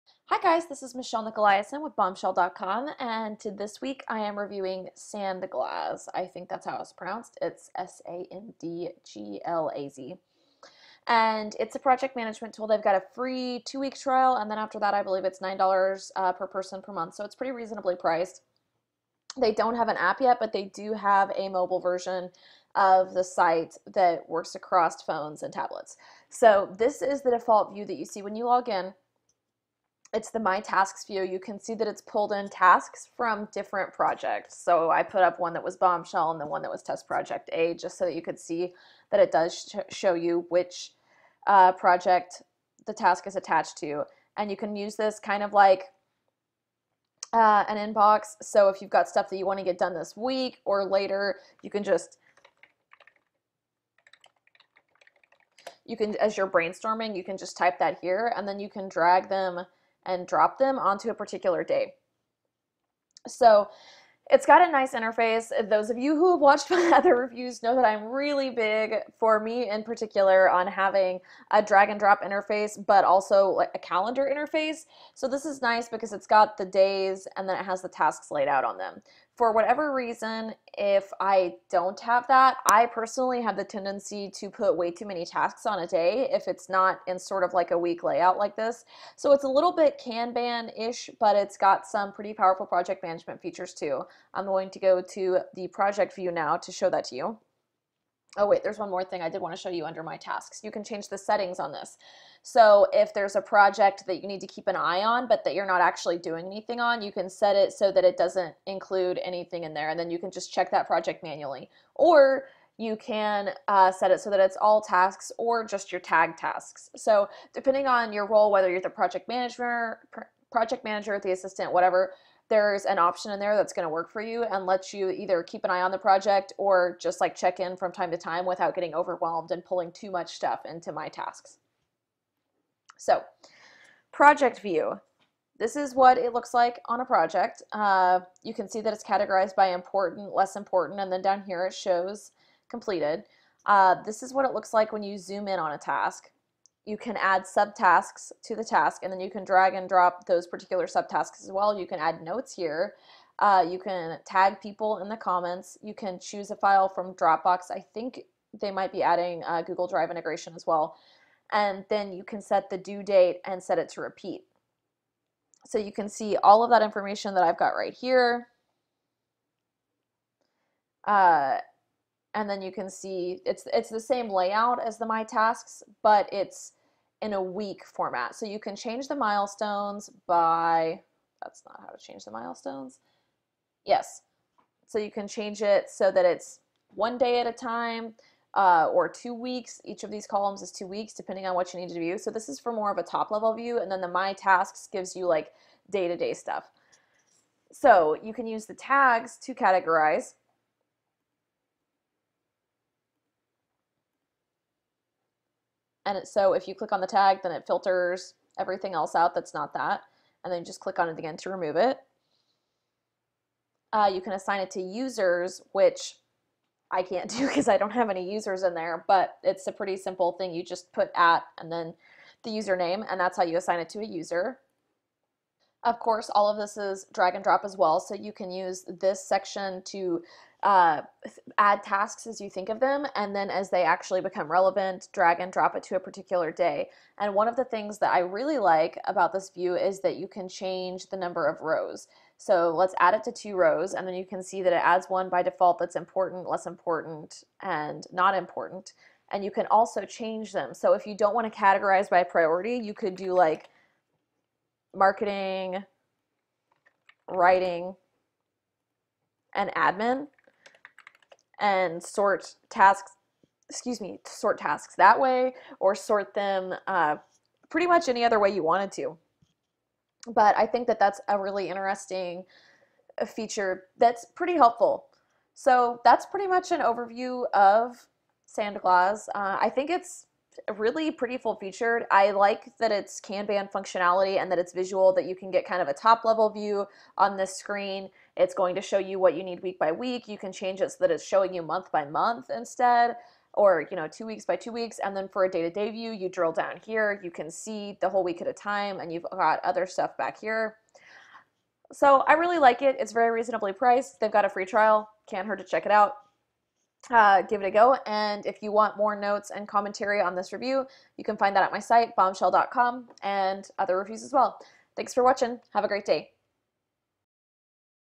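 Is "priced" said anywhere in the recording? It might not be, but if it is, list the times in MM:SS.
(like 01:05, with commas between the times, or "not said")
00:17, 05:03.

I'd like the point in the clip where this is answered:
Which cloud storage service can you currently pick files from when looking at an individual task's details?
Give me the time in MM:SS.
02:37.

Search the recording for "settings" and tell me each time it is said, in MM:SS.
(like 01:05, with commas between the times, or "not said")
01:41.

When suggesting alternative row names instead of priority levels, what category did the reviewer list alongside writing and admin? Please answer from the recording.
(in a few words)
marketing.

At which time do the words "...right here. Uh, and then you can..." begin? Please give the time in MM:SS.
02:47.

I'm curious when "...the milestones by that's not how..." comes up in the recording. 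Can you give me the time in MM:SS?
02:59.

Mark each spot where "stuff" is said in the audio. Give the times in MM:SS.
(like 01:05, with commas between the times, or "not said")
00:49, 02:10, 03:16, 04:59.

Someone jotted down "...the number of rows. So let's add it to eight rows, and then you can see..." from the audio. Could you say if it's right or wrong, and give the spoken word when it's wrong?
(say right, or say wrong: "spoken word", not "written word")
wrong: "two", not "eight".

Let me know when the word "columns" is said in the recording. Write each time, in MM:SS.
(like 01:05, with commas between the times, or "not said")
03:10.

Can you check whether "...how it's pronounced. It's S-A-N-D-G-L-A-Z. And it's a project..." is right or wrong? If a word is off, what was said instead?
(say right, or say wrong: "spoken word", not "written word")
right.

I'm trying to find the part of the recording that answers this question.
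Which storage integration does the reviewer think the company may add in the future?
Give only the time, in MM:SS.
02:39.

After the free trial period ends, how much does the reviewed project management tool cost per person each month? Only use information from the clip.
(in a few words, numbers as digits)
$9.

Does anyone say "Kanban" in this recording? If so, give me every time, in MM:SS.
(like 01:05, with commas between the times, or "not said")
01:29, 04:43.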